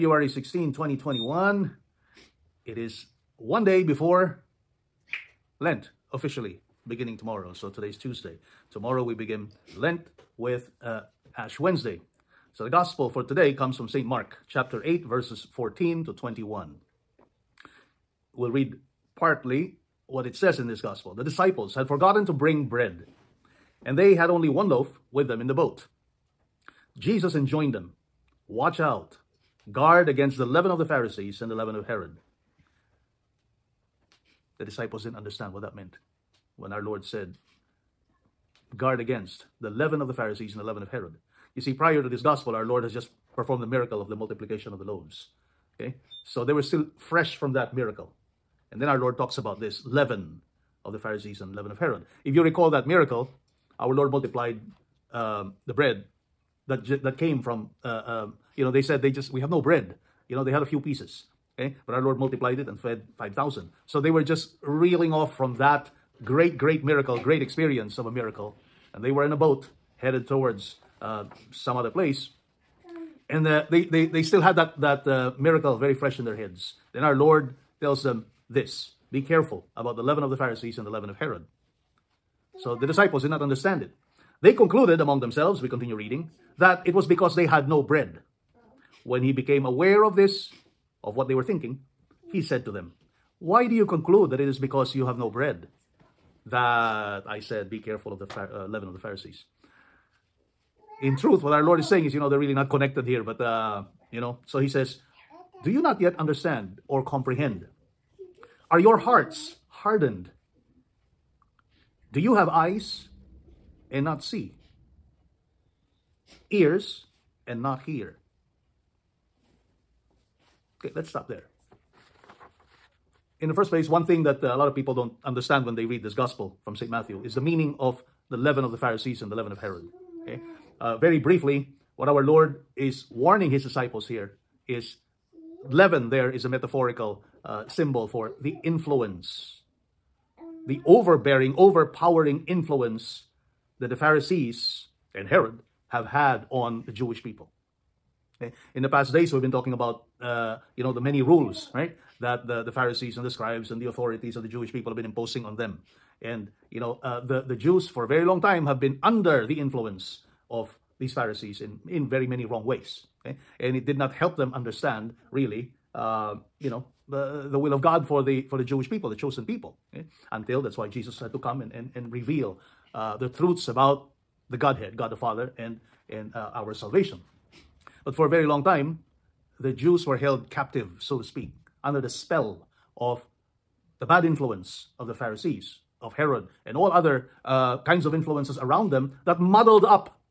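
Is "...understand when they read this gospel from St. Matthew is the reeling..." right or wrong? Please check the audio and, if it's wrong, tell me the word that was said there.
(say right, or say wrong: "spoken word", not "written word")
wrong: "meaning", not "reeling".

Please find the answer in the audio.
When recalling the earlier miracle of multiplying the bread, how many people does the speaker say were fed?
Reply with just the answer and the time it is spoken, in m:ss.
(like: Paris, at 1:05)
5000, at 1:03.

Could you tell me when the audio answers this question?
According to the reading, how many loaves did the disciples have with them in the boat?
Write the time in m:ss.
0:24.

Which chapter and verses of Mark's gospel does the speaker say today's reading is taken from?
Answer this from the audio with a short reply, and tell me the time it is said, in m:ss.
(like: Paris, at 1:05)
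Chapter 8, verses 14 to 21, at 0:14.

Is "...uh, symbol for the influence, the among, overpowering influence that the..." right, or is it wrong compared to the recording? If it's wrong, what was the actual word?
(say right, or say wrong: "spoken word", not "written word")
wrong: "overbearing", not "among".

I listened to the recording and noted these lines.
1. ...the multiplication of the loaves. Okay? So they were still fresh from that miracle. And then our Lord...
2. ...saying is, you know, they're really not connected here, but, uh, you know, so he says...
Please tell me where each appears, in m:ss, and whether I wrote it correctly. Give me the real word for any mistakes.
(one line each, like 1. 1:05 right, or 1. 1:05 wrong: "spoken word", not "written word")
1. 0:44 right
2. 1:41 right.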